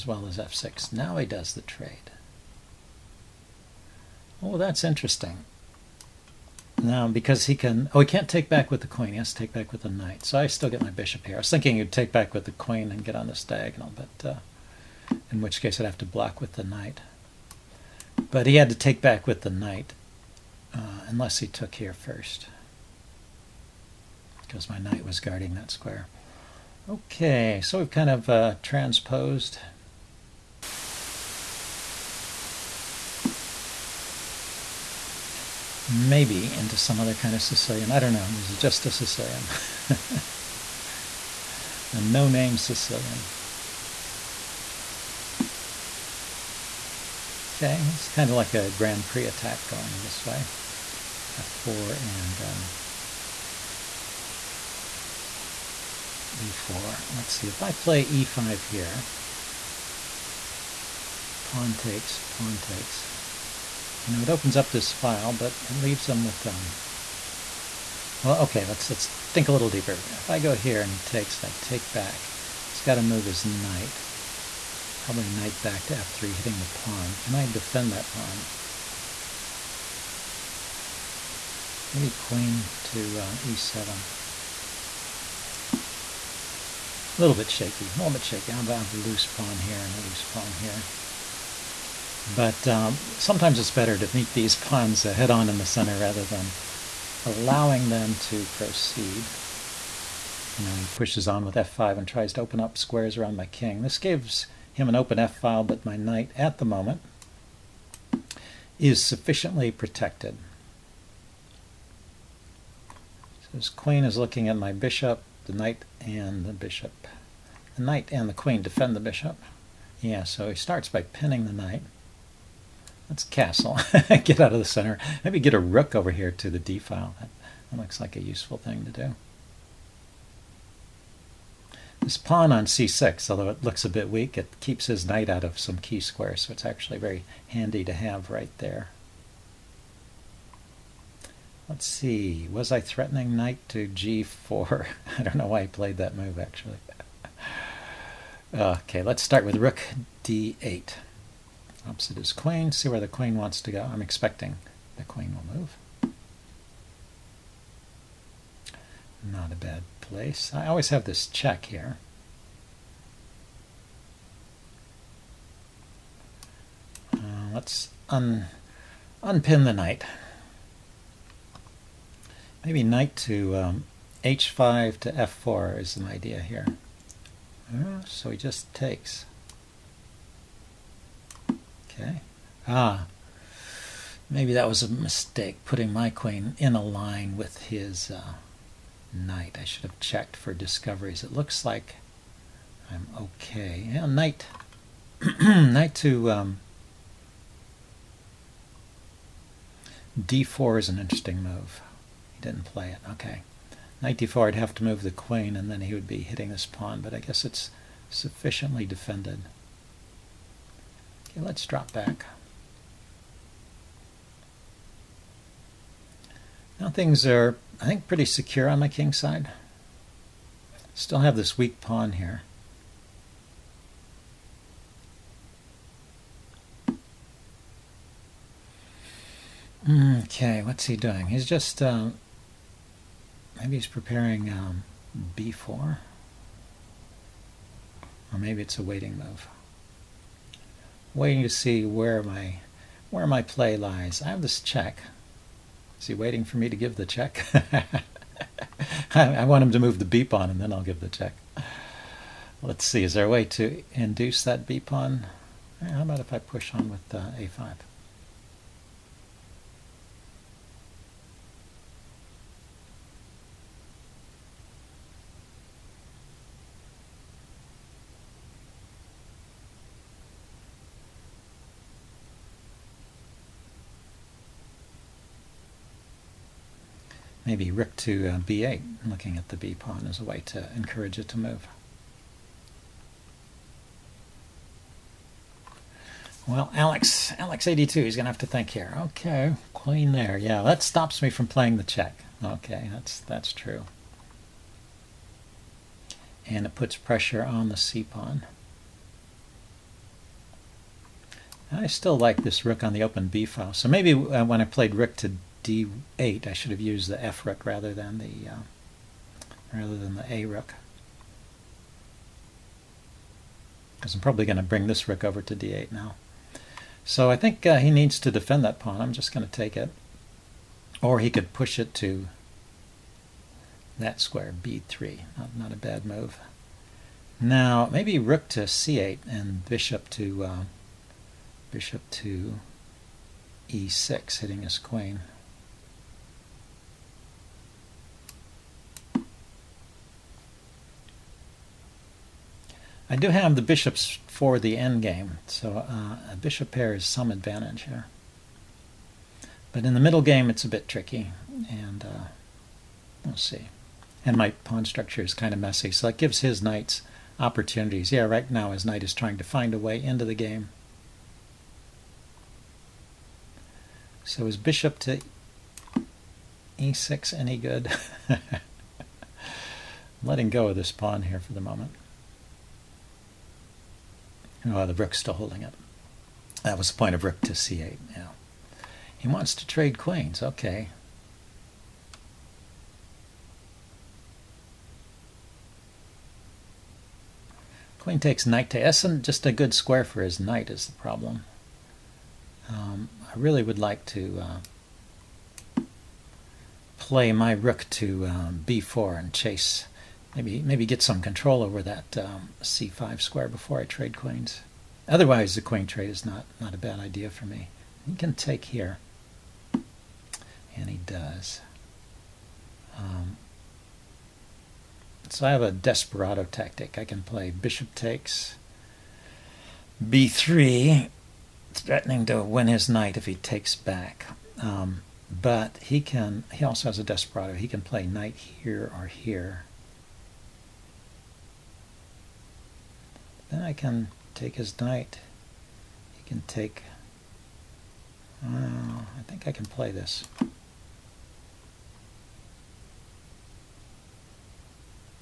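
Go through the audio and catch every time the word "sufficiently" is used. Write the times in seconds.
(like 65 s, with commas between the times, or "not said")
109 s, 208 s.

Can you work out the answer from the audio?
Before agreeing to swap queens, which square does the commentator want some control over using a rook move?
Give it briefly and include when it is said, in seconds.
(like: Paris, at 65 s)
c5, at 402 s.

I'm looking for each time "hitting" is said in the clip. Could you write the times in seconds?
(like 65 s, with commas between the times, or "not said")
76 s, 206 s, 334 s.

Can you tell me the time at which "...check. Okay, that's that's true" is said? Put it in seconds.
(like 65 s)
291 s.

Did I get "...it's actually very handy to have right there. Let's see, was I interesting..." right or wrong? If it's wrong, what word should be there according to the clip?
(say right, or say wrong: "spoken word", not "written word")
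wrong: "threatening", not "interesting".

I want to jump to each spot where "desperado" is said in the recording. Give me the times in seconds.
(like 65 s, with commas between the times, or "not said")
415 s, 427 s.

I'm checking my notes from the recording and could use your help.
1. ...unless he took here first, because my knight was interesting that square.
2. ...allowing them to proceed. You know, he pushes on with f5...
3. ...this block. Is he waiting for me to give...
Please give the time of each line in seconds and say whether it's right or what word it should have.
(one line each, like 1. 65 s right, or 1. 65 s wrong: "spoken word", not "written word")
1. 21 s wrong: "guarding", not "interesting"
2. 97 s right
3. 244 s wrong: "check", not "block".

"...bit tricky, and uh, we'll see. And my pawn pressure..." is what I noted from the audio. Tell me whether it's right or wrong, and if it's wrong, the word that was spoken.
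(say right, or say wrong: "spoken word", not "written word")
wrong: "structure", not "pressure".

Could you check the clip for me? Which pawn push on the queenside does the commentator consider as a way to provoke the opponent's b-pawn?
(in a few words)
a5.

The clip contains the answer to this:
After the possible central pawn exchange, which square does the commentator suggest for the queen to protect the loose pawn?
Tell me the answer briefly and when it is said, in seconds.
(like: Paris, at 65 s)
e7, at 83 s.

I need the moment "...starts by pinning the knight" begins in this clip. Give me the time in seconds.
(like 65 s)
120 s.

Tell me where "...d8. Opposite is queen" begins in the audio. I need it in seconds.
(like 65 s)
150 s.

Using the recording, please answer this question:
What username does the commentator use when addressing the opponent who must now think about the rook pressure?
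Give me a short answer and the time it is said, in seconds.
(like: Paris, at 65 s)
Alex82, at 287 s.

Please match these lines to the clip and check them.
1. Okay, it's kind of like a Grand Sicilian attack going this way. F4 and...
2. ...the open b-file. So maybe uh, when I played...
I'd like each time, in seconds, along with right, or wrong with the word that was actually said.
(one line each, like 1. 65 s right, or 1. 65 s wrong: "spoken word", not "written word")
1. 47 s wrong: "Prix", not "Sicilian"
2. 302 s right.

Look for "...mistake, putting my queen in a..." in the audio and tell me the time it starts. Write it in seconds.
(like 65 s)
184 s.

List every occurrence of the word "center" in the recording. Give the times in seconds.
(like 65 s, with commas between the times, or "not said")
95 s, 124 s.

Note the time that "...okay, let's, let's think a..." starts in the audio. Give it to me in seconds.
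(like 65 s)
68 s.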